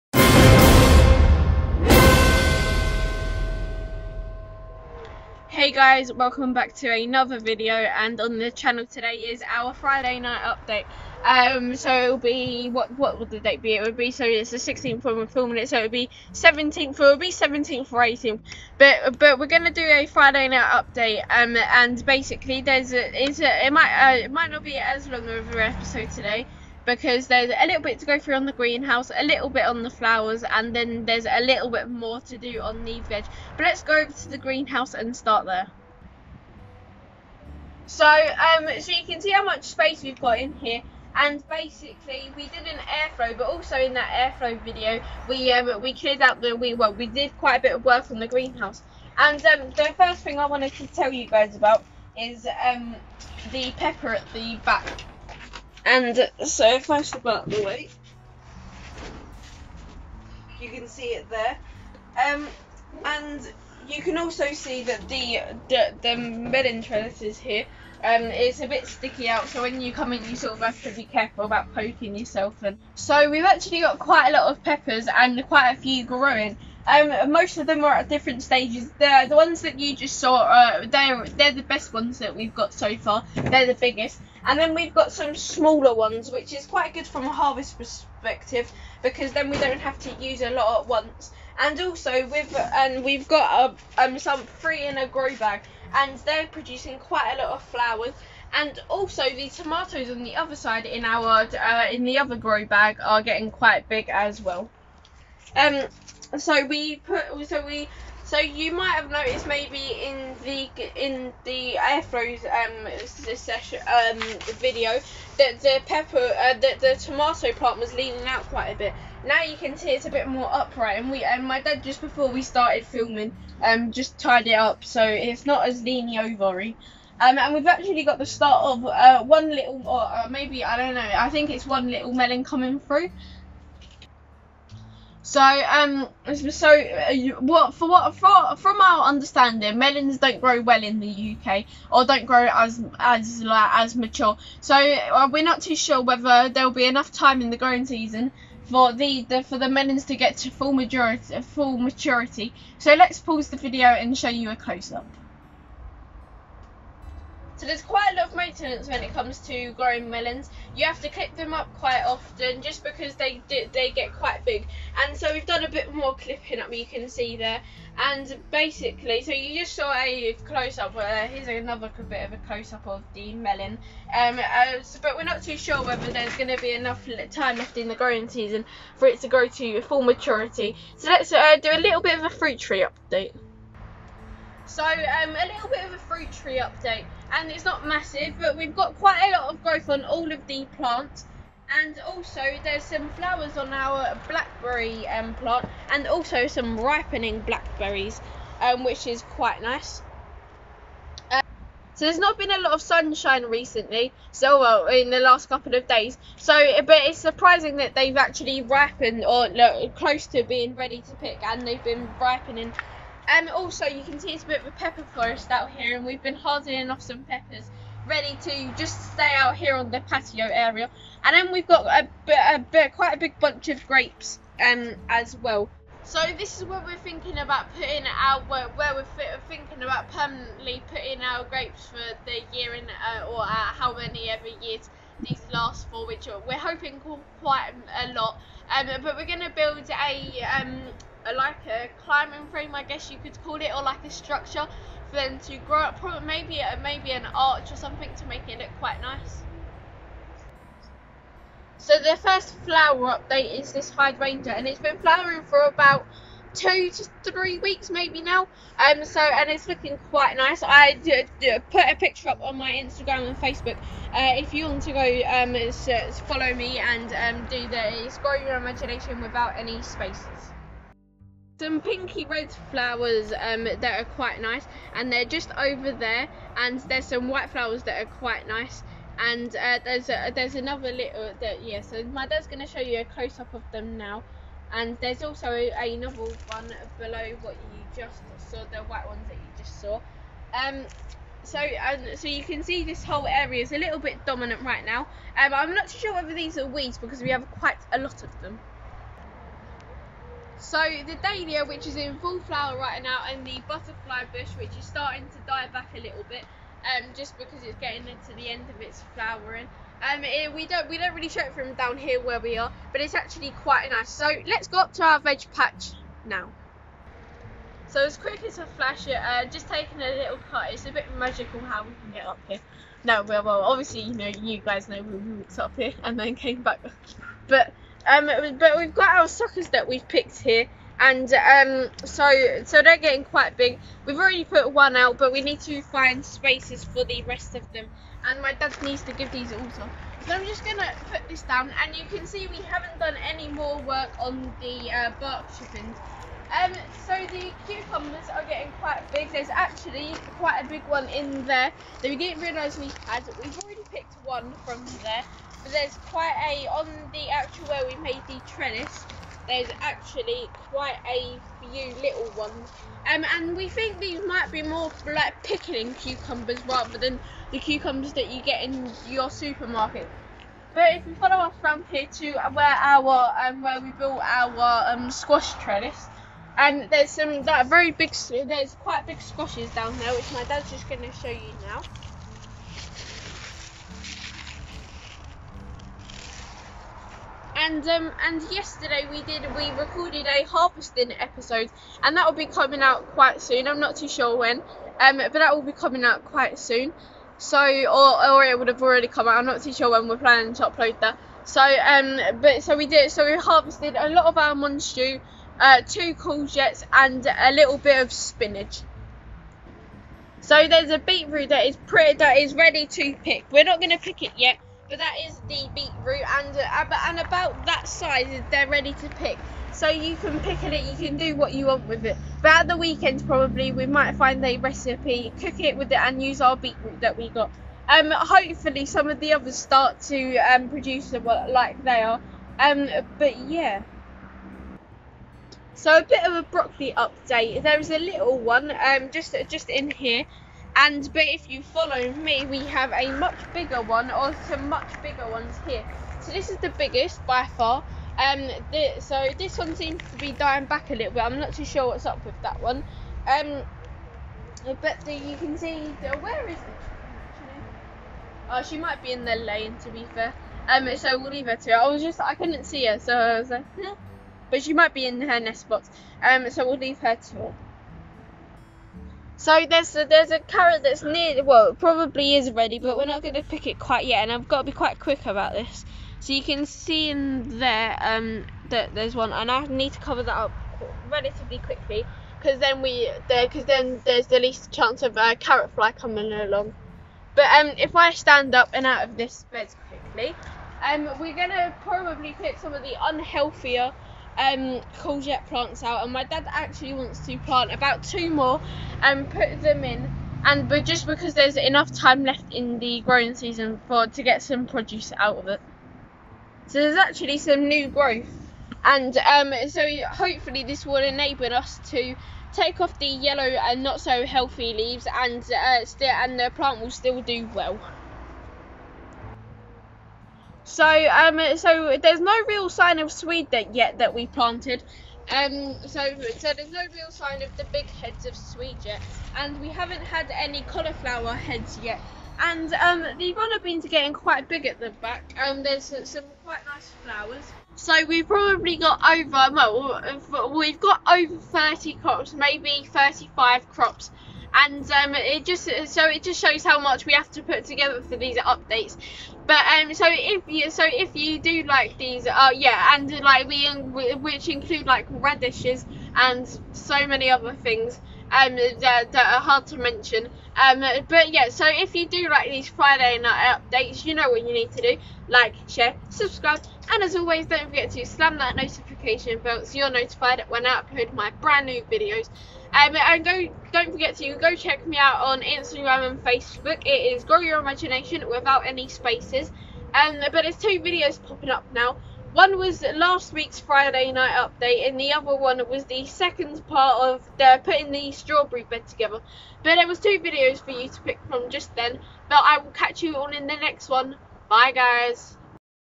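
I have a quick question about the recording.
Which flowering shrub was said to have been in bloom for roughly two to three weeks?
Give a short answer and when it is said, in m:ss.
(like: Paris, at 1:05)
Hydrangea, at 4:13.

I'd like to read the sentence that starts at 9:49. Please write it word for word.
But there was two videos for you to pick from just then.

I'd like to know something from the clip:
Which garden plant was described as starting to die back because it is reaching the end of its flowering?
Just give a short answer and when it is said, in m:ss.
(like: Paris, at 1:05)
Butterfly bush, at 5:03.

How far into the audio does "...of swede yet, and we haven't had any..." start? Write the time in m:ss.
8:48.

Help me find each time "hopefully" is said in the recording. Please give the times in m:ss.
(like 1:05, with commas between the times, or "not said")
7:08, 8:30.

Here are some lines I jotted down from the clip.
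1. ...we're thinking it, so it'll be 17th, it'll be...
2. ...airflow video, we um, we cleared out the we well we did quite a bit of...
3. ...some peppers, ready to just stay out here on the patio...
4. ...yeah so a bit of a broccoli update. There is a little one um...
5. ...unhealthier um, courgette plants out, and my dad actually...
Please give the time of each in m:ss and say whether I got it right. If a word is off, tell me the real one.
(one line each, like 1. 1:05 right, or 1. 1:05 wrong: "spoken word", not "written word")
1. 0:15 wrong: "filming", not "thinking"
2. 0:44 right
3. 3:37 right
4. 7:13 right
5. 8:12 right.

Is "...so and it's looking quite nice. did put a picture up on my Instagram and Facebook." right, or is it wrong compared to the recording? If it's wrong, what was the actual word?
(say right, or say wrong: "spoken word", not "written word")
right.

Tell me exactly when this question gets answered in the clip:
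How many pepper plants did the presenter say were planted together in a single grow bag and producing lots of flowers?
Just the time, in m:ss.
1:34.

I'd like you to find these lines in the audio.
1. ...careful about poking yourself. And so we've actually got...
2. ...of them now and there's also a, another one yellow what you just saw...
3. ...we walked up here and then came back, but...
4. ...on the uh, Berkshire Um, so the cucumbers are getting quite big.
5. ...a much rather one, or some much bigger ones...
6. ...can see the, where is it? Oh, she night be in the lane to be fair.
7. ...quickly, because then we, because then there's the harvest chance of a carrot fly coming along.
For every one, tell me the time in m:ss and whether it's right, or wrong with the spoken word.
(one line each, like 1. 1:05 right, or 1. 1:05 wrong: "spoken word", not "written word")
1. 1:11 right
2. 4:43 wrong: "below", not "yellow"
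3. 5:25 right
4. 5:44 right
5. 7:22 wrong: "bigger", not "rather"
6. 7:35 wrong: "might", not "night"
7. 8:01 wrong: "least", not "harvest".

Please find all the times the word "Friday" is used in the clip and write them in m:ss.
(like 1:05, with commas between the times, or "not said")
0:09, 0:20, 9:22, 9:43.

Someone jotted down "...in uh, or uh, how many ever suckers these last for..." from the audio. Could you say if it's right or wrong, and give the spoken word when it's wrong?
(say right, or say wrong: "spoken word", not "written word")
wrong: "years", not "suckers".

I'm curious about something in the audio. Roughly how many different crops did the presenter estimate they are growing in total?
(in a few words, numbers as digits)
35.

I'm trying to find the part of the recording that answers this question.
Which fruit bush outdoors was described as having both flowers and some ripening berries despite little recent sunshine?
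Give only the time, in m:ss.
3:14.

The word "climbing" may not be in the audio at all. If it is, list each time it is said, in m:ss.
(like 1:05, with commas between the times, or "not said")
4:02.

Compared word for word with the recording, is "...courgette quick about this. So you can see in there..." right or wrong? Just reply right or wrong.
wrong.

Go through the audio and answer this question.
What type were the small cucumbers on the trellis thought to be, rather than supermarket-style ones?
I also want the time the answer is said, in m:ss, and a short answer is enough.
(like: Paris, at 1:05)
Pickling cucumbers, at 6:05.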